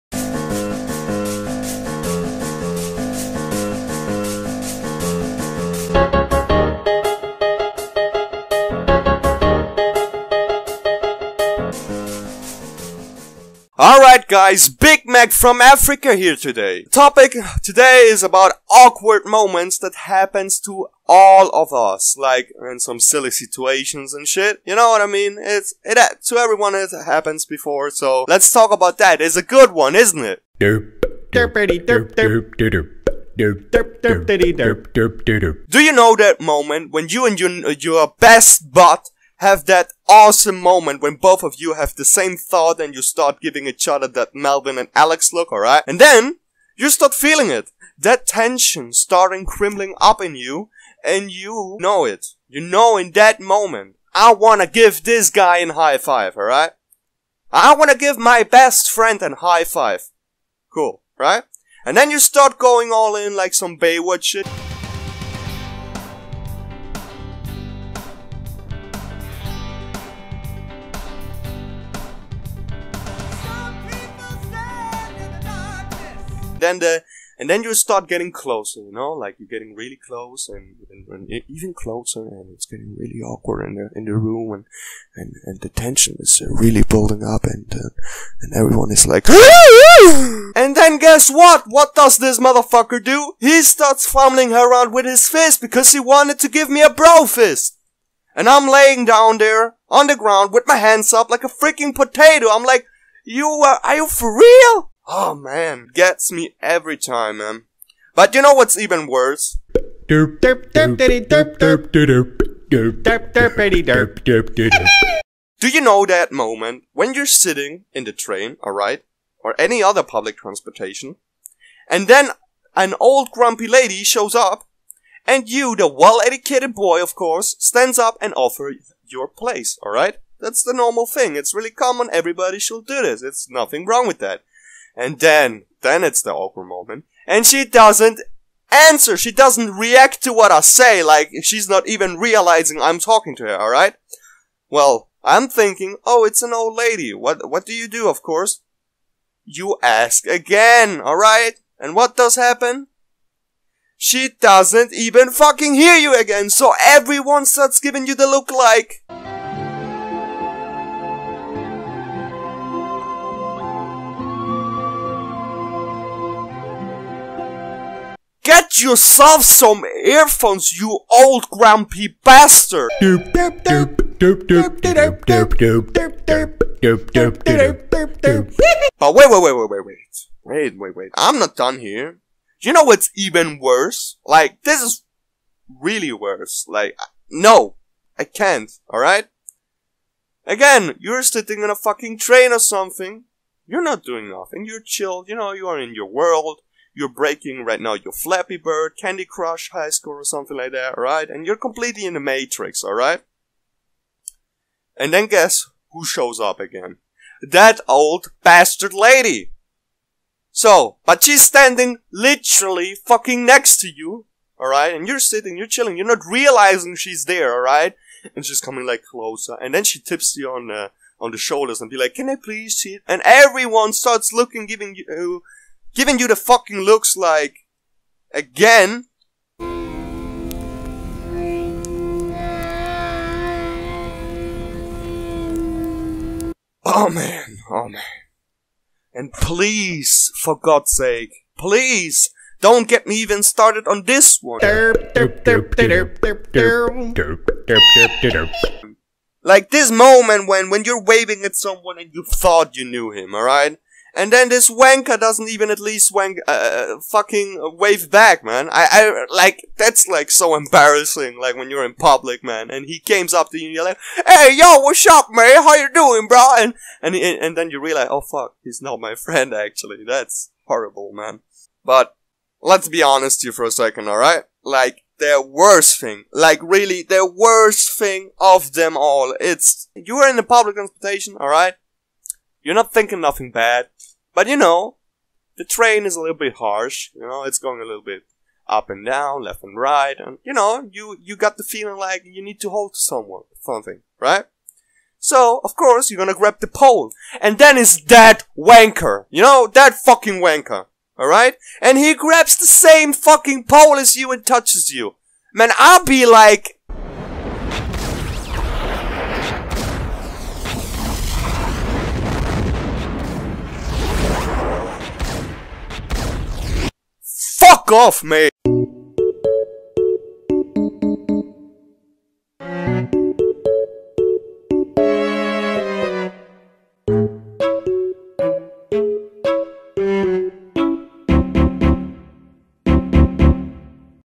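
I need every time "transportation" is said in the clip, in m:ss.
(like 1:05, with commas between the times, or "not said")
2:00, 4:40.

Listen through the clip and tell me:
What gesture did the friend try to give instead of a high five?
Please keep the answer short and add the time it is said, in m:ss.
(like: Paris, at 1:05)
A bro fist, at 1:36.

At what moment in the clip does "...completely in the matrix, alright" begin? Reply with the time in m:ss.
3:21.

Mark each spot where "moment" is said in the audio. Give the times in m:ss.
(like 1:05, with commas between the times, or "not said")
0:19, 0:36, 0:40, 0:53, 1:56, 2:16, 4:09.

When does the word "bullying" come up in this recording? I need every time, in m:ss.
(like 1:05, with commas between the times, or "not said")
not said.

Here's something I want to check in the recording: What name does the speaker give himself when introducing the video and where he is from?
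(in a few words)
Big Mac.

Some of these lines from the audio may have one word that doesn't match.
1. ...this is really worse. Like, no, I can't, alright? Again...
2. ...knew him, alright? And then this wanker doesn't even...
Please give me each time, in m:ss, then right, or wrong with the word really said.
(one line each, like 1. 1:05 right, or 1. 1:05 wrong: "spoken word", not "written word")
1. 3:04 right
2. 4:12 right.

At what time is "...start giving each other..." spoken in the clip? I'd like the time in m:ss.
0:43.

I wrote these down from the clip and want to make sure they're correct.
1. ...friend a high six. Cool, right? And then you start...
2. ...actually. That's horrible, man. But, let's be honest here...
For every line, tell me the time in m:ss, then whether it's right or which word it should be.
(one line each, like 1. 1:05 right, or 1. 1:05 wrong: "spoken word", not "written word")
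1. 0:58 wrong: "five", not "six"
2. 4:29 right.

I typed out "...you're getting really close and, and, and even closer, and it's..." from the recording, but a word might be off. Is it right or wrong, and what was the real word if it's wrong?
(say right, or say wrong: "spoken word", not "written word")
right.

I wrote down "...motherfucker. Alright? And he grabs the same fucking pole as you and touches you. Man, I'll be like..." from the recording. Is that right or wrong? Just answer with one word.
wrong.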